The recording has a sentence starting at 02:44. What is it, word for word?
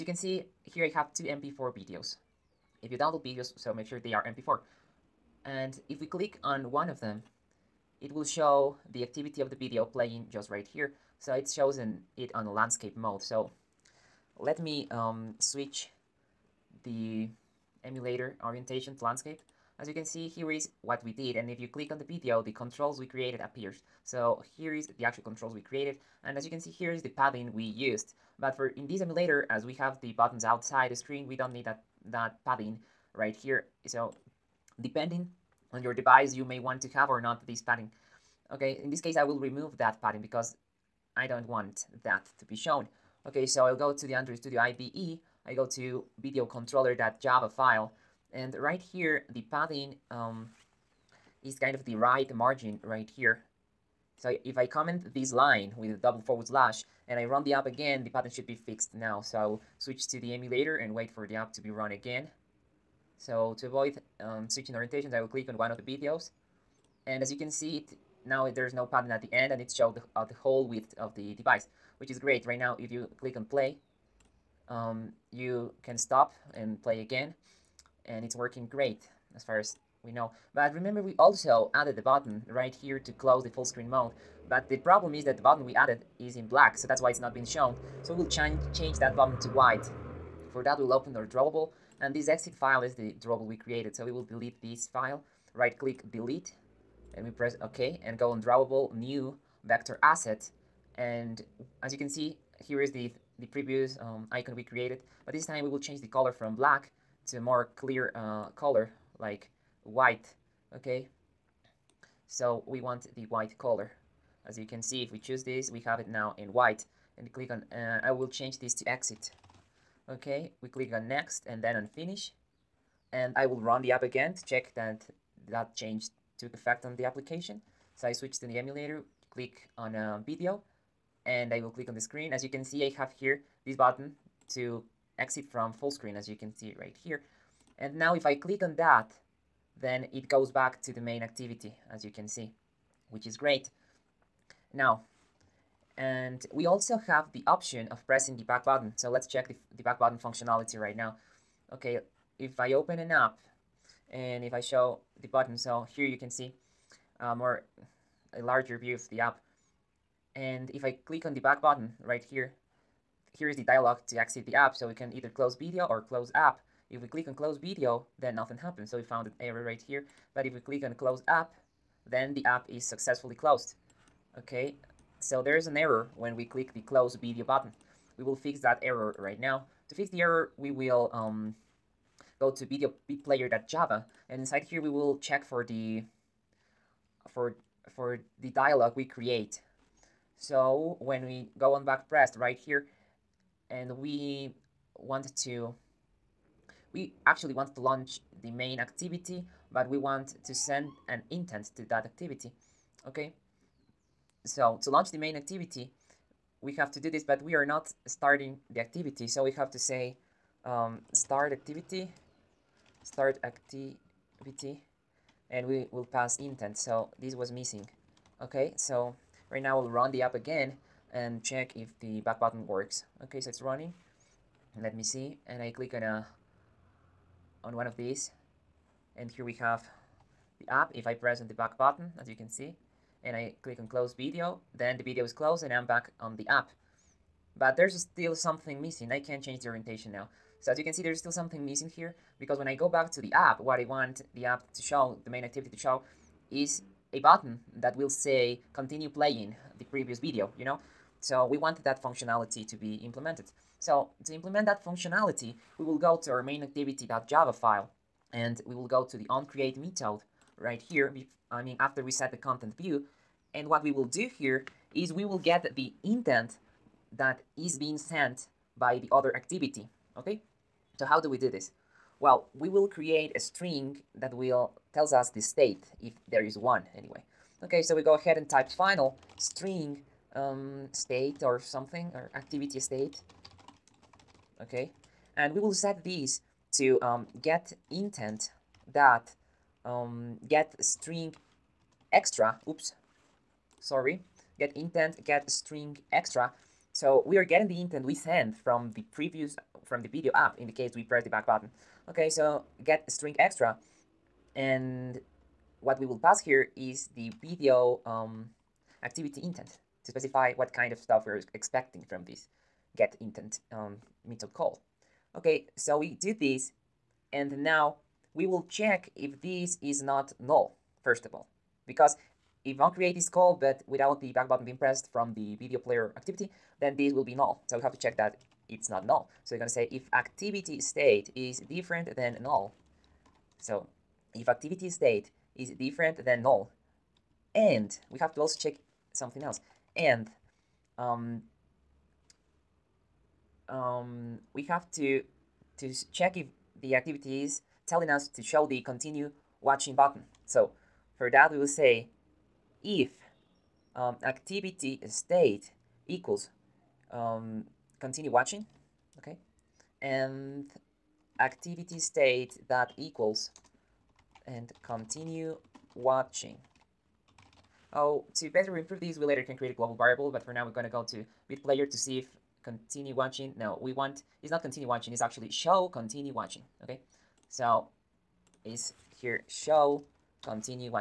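So we can either close video or close app.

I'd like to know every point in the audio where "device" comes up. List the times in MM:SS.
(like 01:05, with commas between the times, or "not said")
00:35, 01:11.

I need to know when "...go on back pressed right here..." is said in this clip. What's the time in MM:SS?
03:11.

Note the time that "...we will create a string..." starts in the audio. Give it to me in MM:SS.
04:32.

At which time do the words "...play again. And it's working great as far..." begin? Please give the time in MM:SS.
01:16.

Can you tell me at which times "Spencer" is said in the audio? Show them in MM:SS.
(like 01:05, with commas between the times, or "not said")
not said.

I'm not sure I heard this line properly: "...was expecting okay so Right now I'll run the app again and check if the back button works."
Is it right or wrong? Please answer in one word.
wrong.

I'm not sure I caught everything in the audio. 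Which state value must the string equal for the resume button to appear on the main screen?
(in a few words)
show continue watching.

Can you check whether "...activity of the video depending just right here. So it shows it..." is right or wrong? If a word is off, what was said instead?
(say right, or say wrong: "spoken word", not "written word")
wrong: "playing", not "depending".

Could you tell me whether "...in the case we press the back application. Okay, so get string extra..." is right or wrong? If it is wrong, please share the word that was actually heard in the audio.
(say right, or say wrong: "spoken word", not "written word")
wrong: "button", not "application".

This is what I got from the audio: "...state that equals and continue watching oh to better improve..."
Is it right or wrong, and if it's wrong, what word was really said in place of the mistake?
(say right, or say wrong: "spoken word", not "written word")
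right.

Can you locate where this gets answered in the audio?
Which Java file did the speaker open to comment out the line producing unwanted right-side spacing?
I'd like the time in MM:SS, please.
00:46.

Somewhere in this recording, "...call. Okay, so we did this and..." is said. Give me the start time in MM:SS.
05:14.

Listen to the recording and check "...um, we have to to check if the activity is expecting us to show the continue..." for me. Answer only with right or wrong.
wrong.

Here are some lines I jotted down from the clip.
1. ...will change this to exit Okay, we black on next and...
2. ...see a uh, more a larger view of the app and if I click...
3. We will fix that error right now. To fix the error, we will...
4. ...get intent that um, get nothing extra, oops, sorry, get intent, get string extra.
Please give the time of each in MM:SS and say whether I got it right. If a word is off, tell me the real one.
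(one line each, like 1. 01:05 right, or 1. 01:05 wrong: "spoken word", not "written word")
1. 01:58 wrong: "click", not "black"
2. 02:36 right
3. 02:58 right
4. 04:47 wrong: "string", not "nothing".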